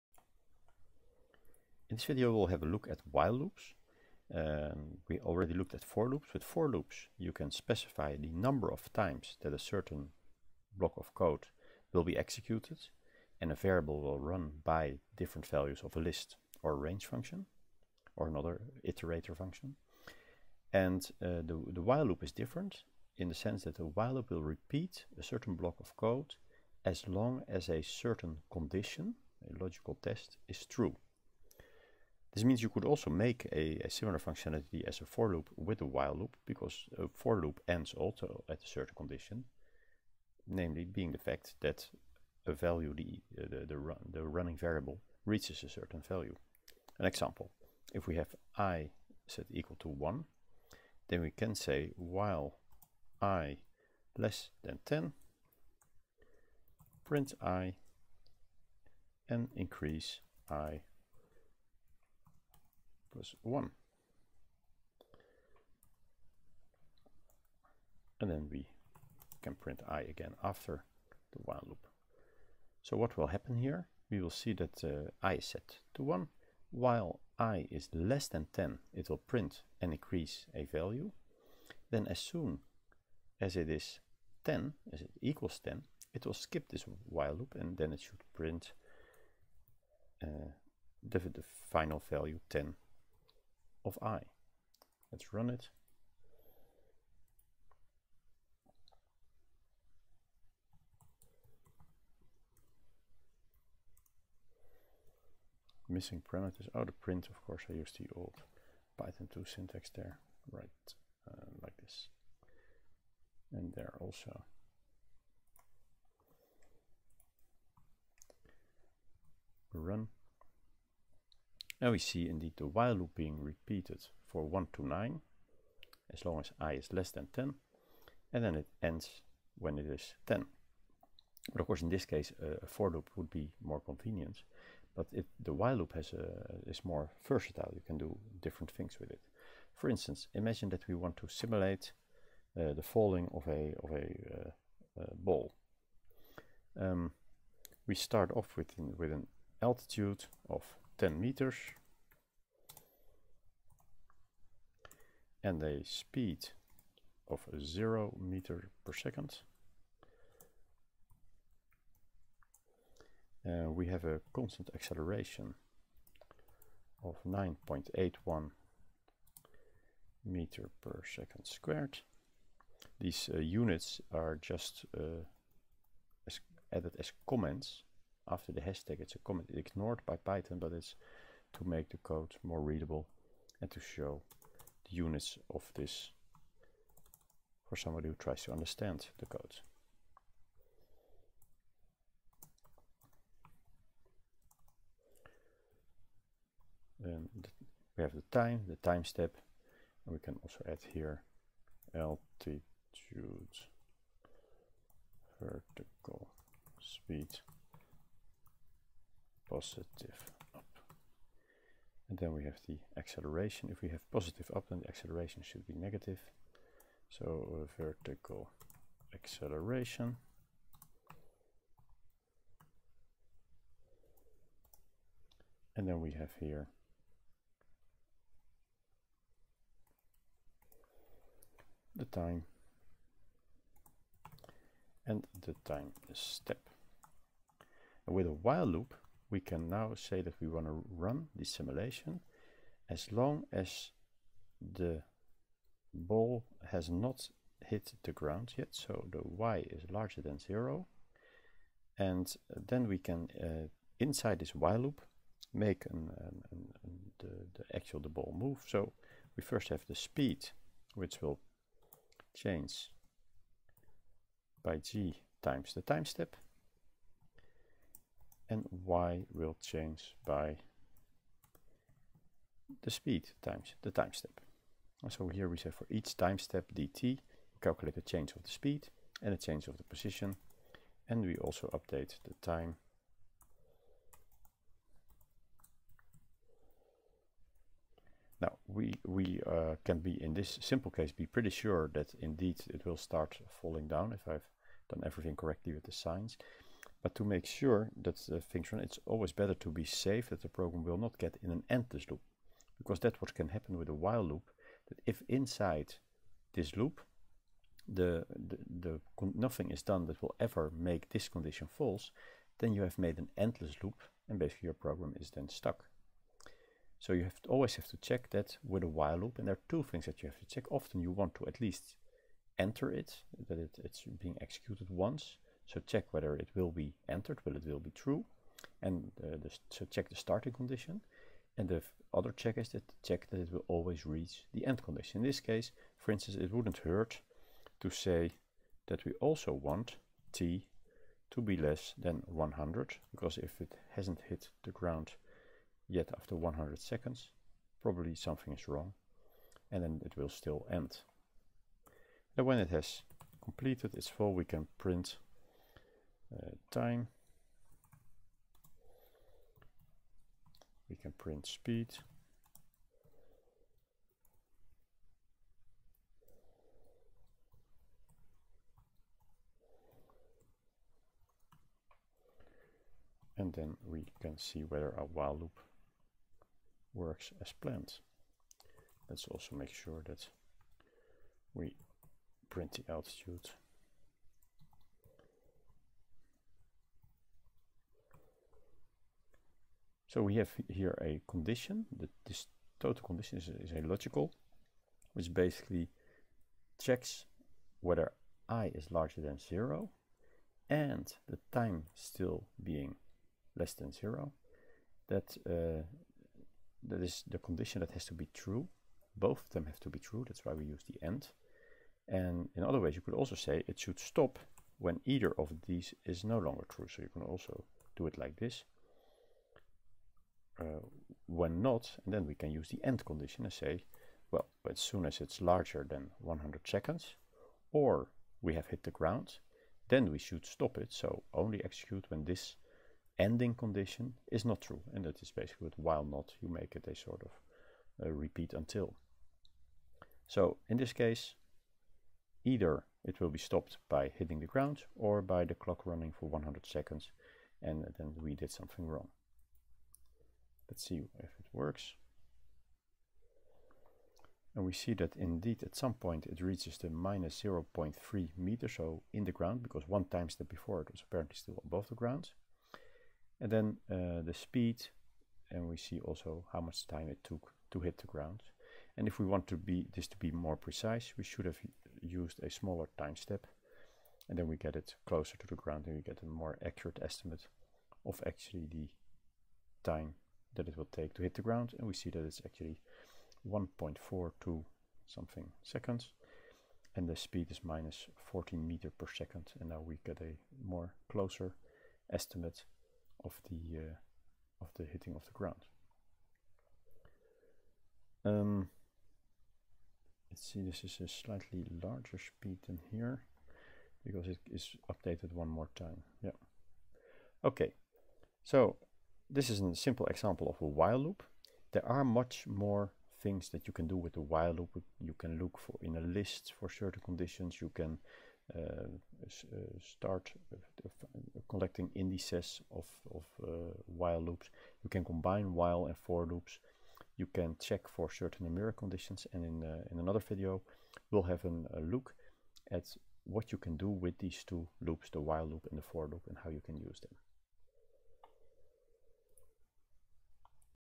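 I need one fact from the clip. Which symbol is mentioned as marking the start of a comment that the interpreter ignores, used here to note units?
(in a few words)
hashtag.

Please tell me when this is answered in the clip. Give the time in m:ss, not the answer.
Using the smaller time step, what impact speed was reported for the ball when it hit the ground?
8:07.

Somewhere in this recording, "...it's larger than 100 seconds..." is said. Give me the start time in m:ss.
7:05.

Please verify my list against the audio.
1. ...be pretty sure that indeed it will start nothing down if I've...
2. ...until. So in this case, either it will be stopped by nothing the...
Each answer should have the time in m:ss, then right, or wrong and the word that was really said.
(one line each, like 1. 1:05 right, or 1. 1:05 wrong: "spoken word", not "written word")
1. 4:51 wrong: "falling", not "nothing"
2. 7:18 wrong: "hitting", not "nothing".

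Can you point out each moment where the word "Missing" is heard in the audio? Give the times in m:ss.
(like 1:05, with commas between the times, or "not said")
1:45.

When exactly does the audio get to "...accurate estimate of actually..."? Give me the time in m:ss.
7:56.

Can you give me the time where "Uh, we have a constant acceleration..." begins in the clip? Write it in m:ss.
2:43.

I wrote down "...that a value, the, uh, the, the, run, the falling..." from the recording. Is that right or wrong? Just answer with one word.
wrong.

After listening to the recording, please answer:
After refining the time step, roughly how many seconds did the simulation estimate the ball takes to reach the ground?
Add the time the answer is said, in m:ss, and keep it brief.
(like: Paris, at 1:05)
1.42 seconds, at 8:03.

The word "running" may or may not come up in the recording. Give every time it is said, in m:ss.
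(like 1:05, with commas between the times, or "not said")
0:44, 7:25.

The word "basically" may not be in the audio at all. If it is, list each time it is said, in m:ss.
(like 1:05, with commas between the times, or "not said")
5:14, 6:35, 7:15.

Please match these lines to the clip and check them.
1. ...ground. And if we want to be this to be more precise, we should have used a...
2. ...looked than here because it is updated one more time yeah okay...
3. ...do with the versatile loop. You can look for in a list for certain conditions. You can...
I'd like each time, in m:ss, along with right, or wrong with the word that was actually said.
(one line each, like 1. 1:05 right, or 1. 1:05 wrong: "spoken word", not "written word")
1. 7:48 right
2. 8:22 wrong: "speed", not "looked"
3. 8:33 wrong: "while", not "versatile".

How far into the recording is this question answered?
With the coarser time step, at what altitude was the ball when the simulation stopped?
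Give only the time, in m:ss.
7:36.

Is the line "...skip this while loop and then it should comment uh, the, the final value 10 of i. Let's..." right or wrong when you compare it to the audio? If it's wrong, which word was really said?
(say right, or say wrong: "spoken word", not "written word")
wrong: "print", not "comment".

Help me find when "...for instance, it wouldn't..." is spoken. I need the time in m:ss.
5:35.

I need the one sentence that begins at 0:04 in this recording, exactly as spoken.
Um, we already looked at for loops.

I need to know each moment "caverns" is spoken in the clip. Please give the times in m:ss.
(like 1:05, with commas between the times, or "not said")
not said.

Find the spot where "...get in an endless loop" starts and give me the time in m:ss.
5:01.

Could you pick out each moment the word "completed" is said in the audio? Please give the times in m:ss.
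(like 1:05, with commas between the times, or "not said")
5:53.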